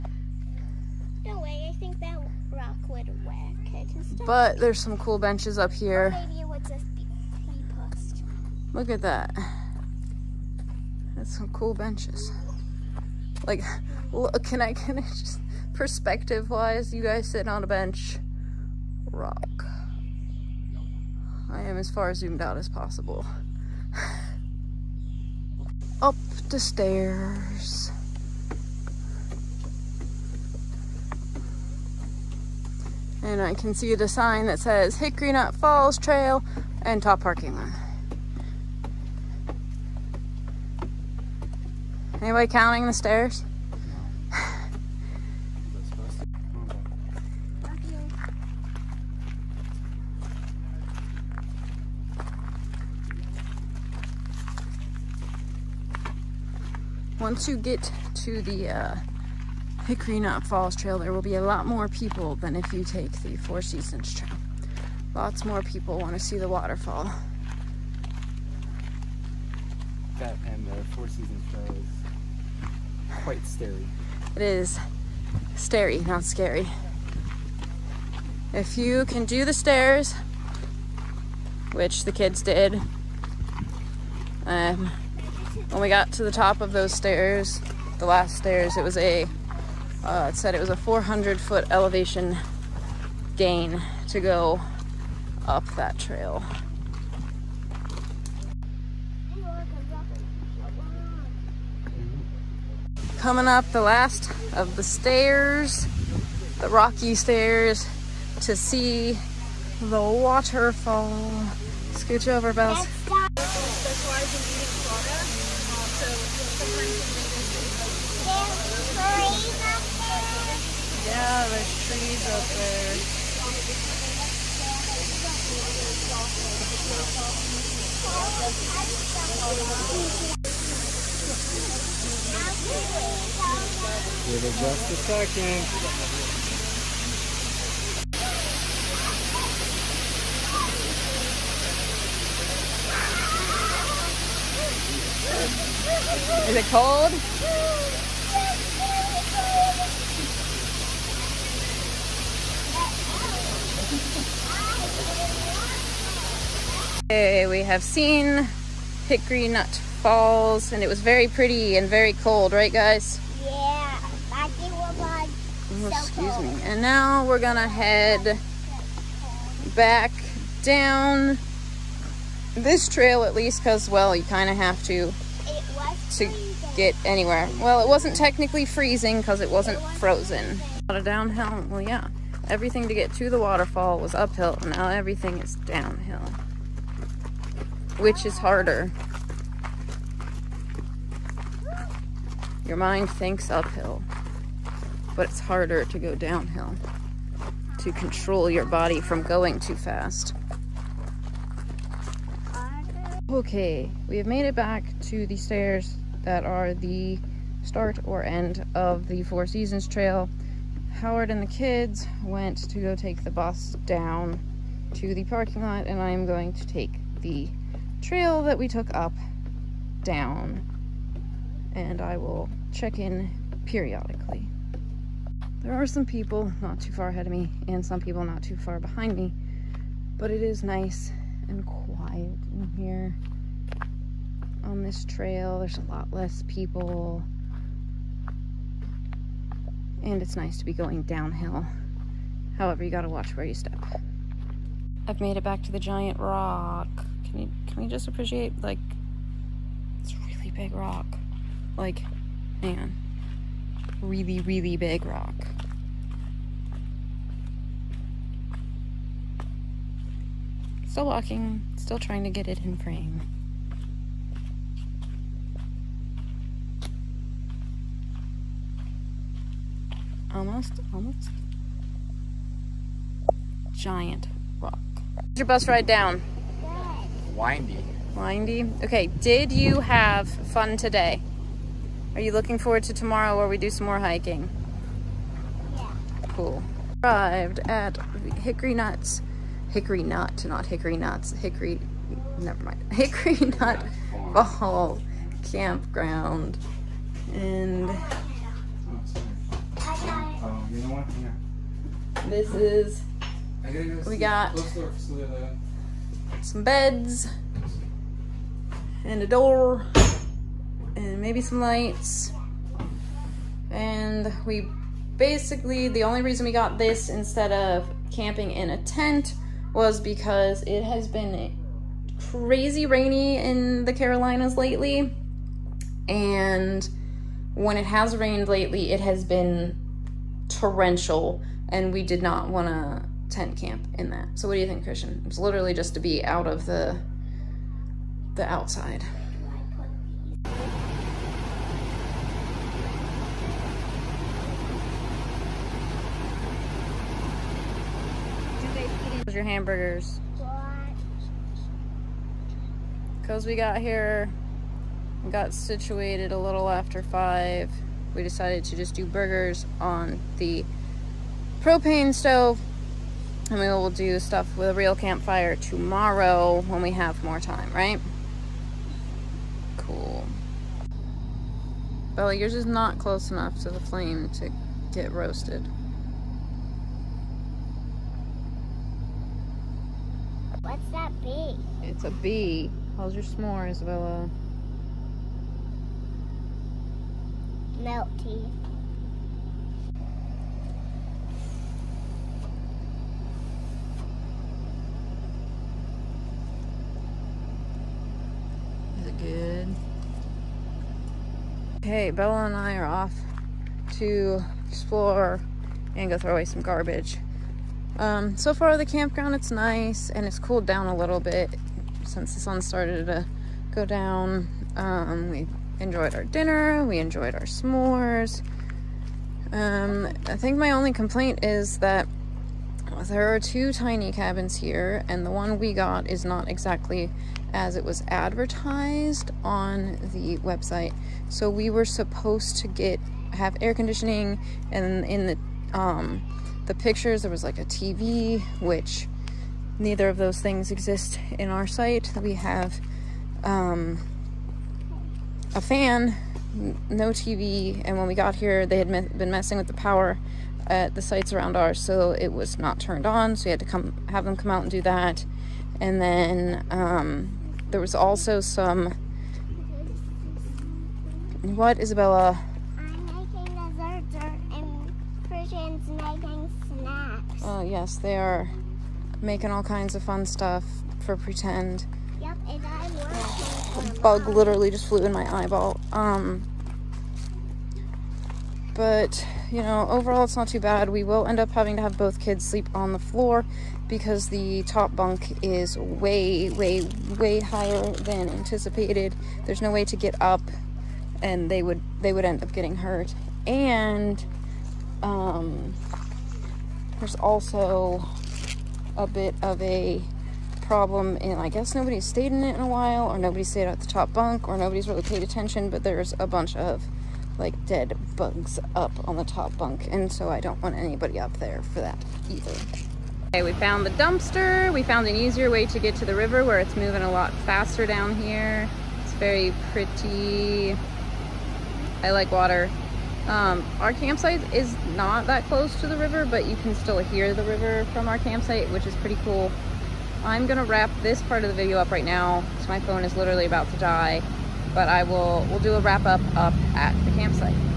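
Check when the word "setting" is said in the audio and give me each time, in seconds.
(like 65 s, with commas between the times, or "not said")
not said.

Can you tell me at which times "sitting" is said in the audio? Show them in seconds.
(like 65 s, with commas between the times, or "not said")
17 s.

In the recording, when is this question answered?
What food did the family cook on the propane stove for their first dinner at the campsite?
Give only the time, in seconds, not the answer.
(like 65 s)
359 s.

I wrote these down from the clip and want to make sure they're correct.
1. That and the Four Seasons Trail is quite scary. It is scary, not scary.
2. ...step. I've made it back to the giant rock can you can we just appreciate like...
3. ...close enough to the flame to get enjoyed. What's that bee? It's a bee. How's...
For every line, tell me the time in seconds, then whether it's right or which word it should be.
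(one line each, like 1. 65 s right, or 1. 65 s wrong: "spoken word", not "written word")
1. 70 s right
2. 243 s right
3. 372 s wrong: "roasted", not "enjoyed".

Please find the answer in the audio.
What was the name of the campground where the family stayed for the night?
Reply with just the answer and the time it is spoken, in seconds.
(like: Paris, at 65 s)
Hickory Nut Fall Campground, at 292 s.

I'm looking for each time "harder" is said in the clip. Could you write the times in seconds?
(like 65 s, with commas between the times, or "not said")
188 s, 195 s.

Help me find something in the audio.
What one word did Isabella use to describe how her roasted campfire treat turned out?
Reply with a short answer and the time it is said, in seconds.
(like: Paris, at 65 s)
Melty, at 387 s.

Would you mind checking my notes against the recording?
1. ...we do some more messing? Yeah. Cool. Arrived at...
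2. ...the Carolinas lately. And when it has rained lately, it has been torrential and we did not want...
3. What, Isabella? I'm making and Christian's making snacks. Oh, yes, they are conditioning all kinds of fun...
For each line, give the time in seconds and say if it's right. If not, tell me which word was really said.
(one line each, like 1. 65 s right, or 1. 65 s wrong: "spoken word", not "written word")
1. 283 s wrong: "hiking", not "messing"
2. 323 s right
3. 461 s wrong: "making", not "conditioning".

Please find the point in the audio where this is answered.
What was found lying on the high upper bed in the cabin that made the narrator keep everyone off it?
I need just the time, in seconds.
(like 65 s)
507 s.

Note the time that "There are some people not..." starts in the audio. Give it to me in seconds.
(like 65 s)
225 s.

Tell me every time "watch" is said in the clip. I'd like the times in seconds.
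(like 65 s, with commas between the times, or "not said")
243 s.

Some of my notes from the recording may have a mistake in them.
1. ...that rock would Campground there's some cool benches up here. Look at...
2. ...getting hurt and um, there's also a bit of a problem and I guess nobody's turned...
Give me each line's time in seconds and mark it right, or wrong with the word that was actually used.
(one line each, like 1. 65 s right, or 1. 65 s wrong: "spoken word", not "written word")
1. 1 s wrong: "But", not "Campground"
2. 492 s wrong: "stayed", not "turned".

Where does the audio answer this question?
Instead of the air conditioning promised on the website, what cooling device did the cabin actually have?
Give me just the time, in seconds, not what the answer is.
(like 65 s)
445 s.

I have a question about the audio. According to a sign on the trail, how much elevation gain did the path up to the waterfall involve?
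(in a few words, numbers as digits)
400 feet.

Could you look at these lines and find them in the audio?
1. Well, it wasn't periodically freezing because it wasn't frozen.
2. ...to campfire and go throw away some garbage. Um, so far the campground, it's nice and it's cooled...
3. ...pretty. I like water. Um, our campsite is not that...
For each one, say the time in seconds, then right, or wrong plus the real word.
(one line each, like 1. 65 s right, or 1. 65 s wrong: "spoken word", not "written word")
1. 177 s wrong: "technically", not "periodically"
2. 403 s wrong: "explore", not "campfire"
3. 519 s right.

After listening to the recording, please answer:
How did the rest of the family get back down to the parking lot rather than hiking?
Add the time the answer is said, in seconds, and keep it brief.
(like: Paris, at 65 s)
The bus, at 213 s.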